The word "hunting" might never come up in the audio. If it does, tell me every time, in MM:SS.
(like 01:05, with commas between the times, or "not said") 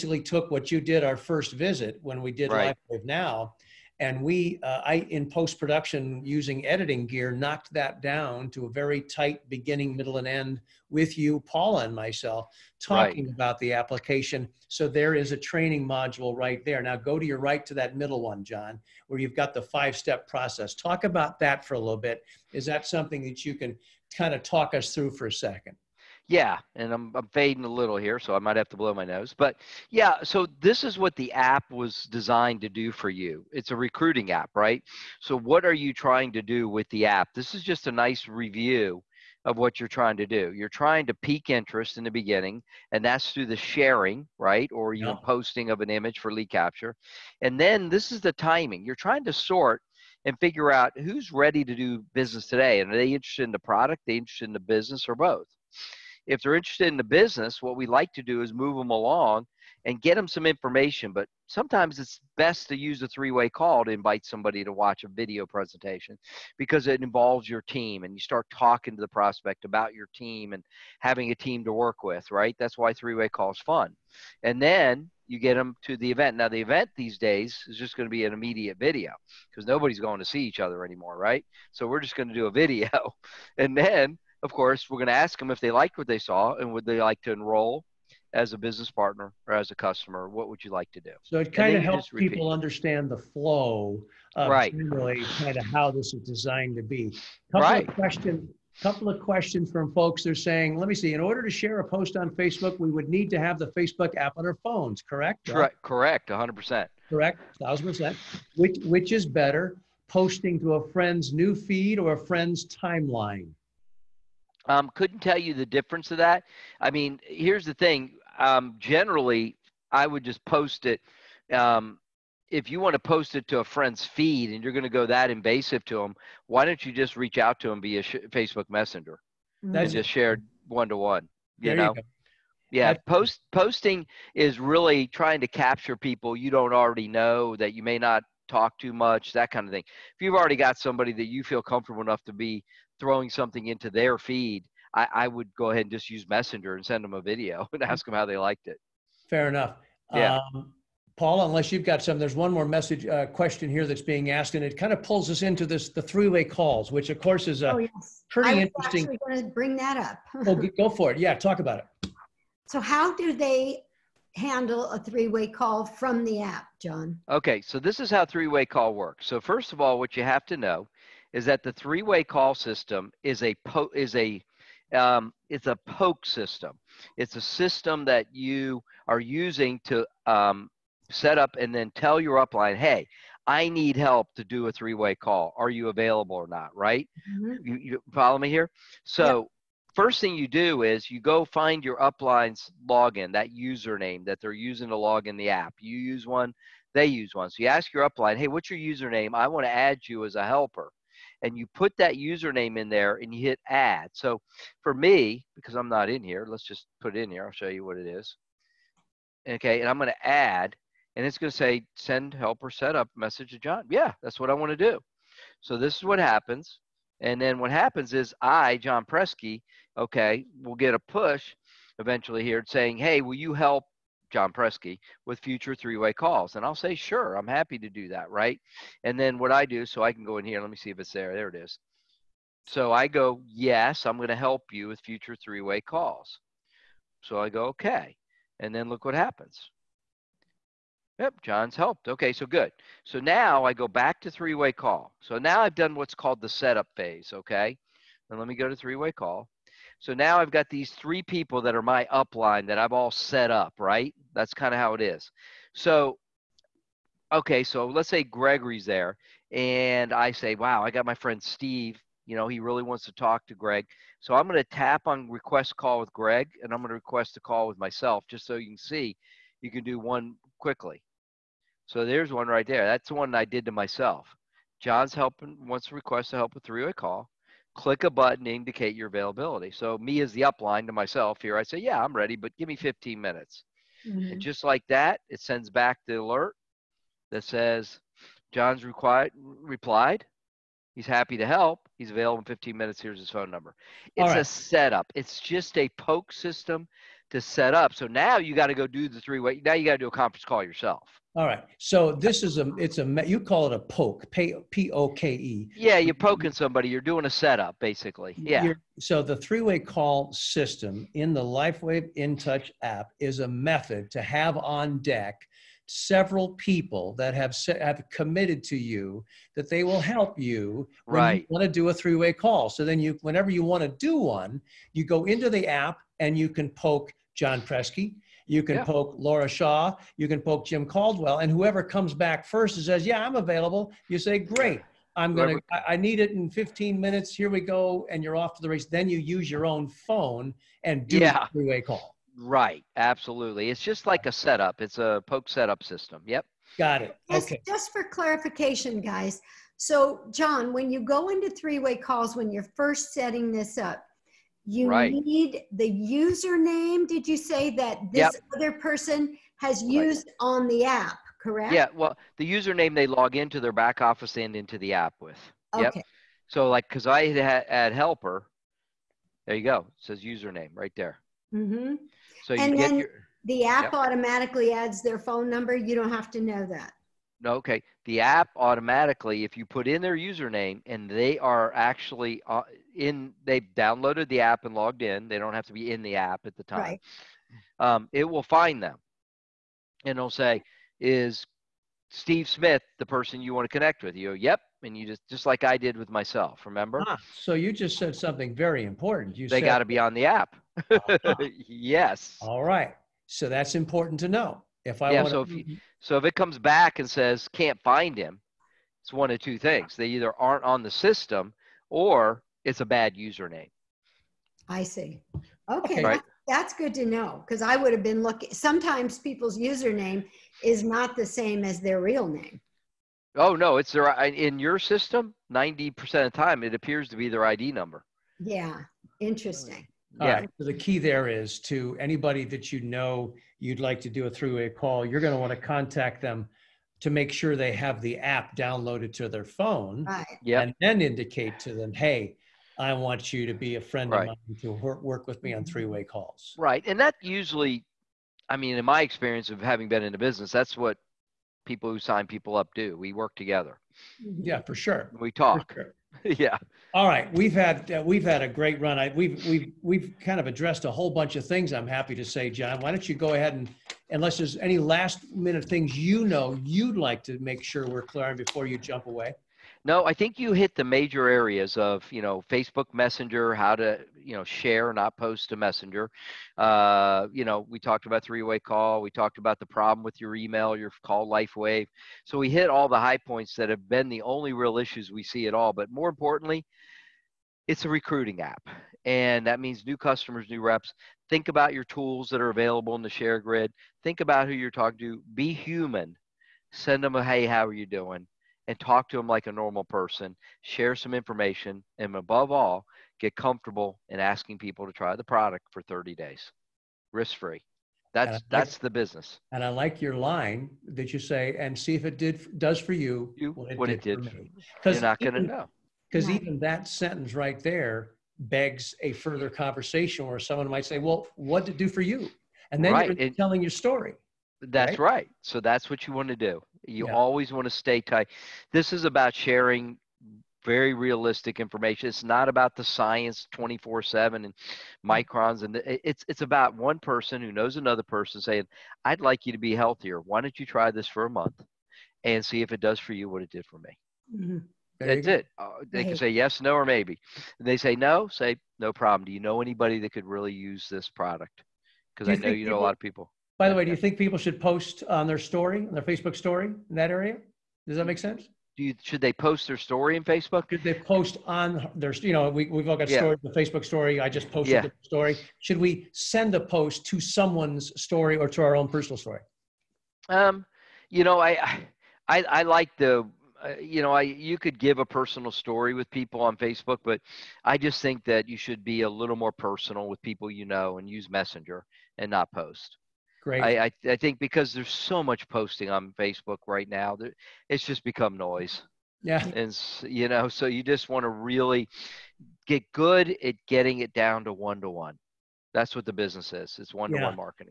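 not said.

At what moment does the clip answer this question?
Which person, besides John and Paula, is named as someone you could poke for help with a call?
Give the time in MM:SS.
05:30.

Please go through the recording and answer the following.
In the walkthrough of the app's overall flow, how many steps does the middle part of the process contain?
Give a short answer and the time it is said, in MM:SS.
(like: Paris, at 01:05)
5, at 00:19.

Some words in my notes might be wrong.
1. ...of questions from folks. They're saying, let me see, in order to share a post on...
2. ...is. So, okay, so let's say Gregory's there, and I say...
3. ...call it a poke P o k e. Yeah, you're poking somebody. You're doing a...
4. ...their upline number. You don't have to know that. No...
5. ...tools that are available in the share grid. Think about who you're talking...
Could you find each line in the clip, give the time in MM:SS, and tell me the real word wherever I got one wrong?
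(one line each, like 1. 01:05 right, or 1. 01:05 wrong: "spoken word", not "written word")
1. 01:39 right
2. 04:15 right
3. 05:03 right
4. 06:15 wrong: "phone", not "upline"
5. 08:11 right.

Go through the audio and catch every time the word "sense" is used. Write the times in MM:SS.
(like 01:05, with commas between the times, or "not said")
09:18.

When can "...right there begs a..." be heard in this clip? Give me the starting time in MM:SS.
08:37.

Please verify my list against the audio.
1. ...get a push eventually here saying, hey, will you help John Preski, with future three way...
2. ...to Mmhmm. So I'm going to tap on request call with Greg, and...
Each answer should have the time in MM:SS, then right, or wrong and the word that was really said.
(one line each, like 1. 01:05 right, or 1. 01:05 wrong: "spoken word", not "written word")
1. 03:40 right
2. 04:23 wrong: "Greg", not "Mmhmm".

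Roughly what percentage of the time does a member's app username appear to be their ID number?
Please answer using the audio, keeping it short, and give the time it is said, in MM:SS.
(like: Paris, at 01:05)
90%, at 07:05.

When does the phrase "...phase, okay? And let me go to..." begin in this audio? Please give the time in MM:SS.
04:06.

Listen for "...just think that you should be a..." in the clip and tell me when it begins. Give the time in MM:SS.
09:37.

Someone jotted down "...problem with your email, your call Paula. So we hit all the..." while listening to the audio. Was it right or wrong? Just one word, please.
wrong.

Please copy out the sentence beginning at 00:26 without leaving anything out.
Yeah, and I'm, I'm fading a little here, so I might have to blow my nose.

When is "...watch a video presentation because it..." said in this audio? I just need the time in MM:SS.
01:04.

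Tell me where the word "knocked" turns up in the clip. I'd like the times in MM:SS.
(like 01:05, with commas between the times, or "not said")
00:07.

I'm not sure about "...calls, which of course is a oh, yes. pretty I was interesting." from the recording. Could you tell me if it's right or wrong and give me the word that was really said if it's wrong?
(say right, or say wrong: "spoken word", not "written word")
right.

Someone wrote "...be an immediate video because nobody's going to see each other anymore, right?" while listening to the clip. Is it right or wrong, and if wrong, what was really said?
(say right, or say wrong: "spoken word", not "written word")
right.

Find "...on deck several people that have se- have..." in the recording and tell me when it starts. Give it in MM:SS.
05:14.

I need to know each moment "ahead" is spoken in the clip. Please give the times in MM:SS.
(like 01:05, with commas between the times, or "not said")
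02:25, 07:43.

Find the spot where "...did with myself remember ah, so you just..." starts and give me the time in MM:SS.
06:35.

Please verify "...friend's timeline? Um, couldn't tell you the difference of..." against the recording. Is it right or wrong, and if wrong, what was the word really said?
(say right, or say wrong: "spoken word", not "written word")
right.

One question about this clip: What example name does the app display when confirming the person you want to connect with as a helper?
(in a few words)
Steve Smith.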